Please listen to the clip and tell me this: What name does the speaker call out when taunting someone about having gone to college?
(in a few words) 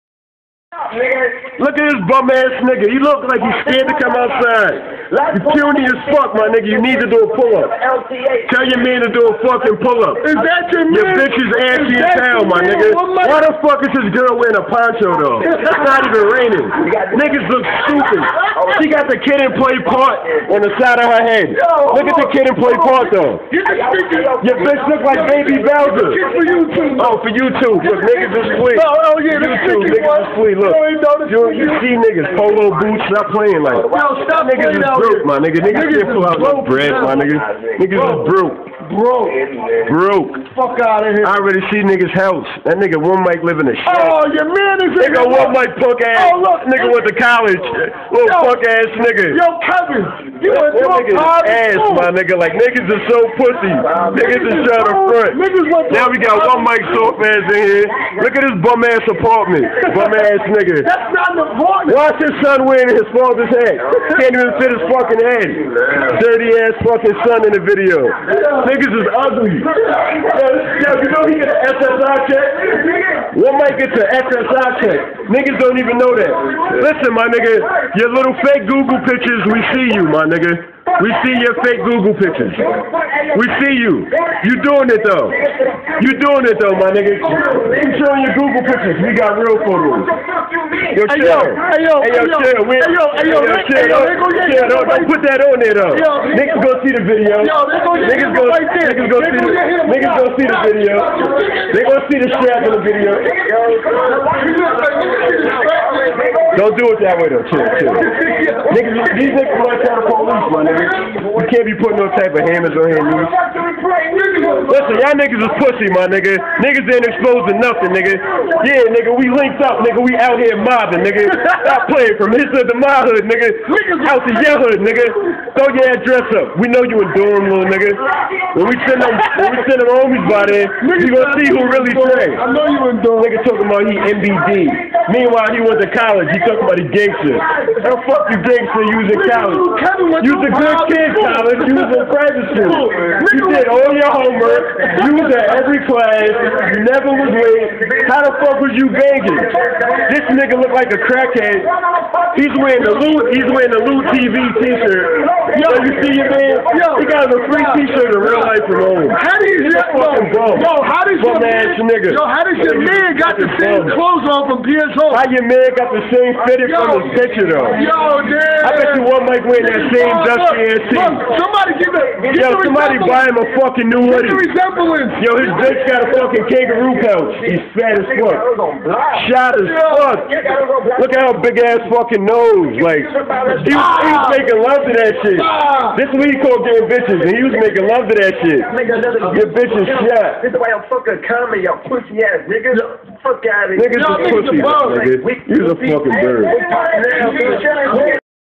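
Kevin.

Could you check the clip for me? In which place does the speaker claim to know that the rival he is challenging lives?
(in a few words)
Durham.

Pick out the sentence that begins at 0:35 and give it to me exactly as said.
Niggas, niggas just broke, my nigga.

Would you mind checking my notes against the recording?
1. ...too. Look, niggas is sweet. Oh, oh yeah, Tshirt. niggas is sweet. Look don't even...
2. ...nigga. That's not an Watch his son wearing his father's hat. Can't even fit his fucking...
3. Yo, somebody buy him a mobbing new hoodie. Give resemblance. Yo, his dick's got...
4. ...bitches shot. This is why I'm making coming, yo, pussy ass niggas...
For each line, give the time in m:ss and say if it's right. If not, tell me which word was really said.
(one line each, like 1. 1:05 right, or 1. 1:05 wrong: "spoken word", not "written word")
1. 0:27 wrong: "YouTube", not "Tshirt"
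2. 1:00 right
3. 2:52 wrong: "fucking", not "mobbing"
4. 3:09 wrong: "fucking", not "making".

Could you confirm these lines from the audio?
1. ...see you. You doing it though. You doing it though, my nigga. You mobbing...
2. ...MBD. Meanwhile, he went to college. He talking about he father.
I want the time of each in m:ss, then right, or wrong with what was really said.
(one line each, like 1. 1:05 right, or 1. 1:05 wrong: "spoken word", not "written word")
1. 1:23 wrong: "showing", not "mobbing"
2. 2:13 wrong: "gangster", not "father".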